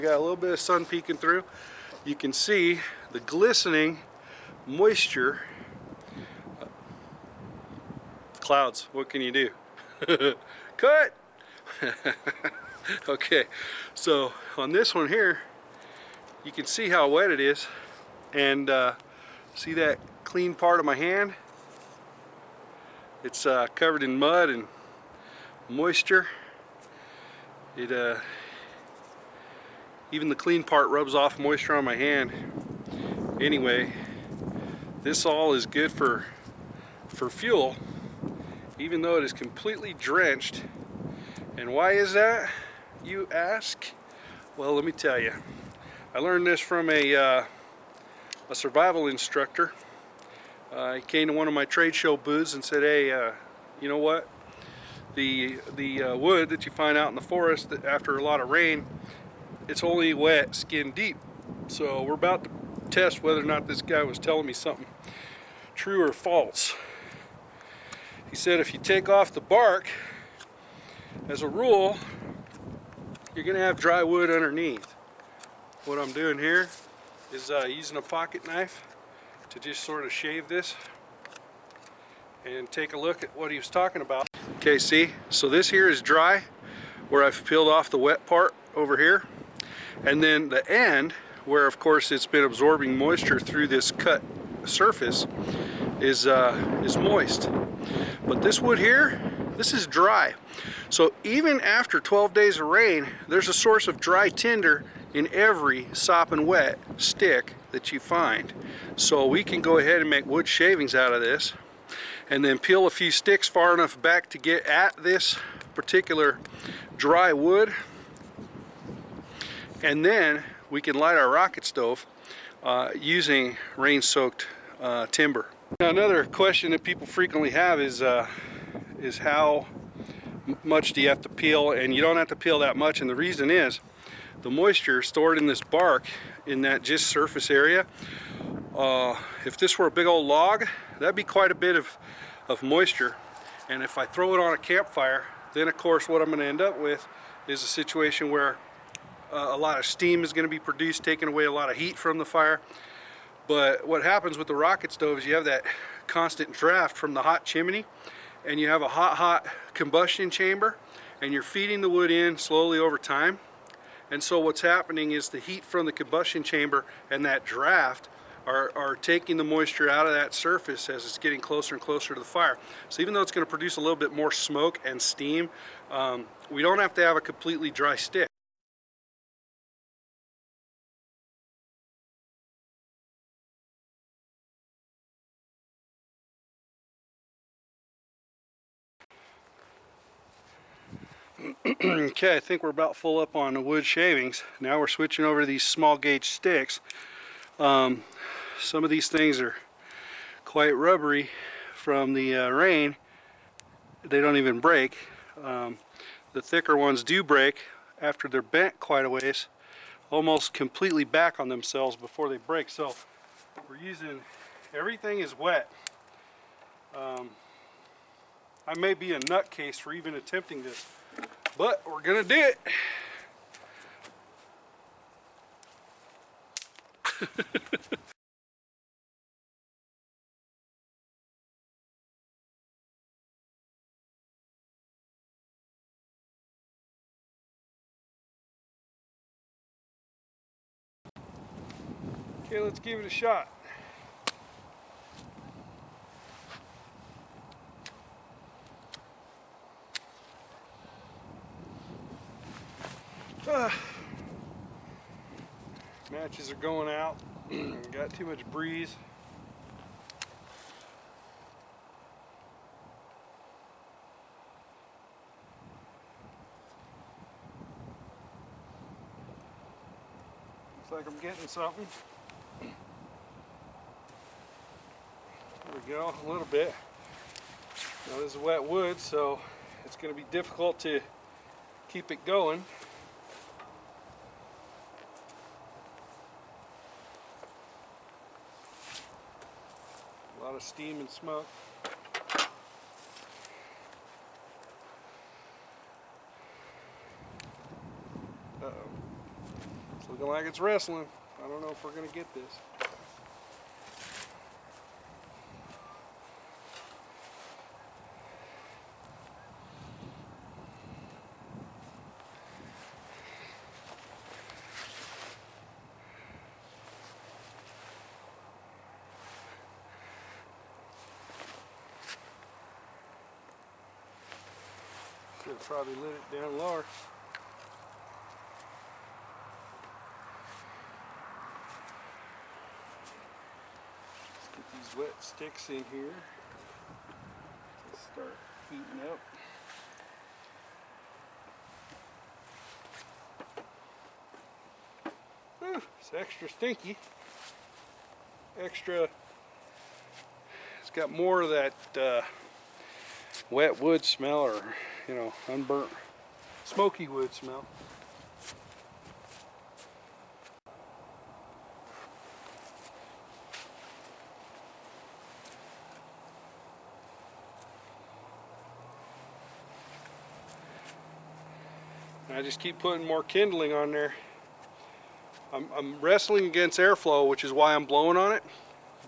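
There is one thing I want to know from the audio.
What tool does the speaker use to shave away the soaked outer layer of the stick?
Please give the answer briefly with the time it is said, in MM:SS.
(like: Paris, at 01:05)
Pocket knife, at 01:18.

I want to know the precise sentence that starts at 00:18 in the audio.
And uh, see that clean part of my hand?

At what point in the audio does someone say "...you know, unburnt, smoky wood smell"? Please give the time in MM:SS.
05:55.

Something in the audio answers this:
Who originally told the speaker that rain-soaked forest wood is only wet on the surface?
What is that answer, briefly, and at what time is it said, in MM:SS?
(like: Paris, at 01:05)
A survival instructor, at 00:48.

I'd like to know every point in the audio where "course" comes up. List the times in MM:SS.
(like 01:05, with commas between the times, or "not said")
01:31, 02:25.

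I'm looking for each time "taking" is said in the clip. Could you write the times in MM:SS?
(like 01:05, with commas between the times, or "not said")
02:31, 02:48.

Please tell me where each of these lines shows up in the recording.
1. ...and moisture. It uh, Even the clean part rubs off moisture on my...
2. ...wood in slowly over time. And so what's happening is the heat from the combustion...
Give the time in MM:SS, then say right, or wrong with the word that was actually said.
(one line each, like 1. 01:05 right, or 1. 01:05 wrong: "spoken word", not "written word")
1. 00:24 right
2. 02:41 right.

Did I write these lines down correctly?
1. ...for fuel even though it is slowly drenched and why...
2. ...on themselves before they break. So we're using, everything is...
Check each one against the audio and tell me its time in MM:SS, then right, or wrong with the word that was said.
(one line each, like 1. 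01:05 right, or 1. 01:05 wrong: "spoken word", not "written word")
1. 00:37 wrong: "completely", not "slowly"
2. 03:31 right.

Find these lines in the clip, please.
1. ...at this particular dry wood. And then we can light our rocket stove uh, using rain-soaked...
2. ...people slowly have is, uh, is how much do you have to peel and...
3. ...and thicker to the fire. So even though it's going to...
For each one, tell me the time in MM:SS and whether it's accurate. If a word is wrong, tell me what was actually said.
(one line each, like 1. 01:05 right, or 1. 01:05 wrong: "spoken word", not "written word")
1. 01:54 right
2. 02:06 wrong: "frequently", not "slowly"
3. 02:51 wrong: "closer", not "thicker".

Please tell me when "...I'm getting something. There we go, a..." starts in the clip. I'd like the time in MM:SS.
04:31.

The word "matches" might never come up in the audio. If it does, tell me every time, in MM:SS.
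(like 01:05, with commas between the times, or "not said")
04:16.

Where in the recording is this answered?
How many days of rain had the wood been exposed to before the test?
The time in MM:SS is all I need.
01:41.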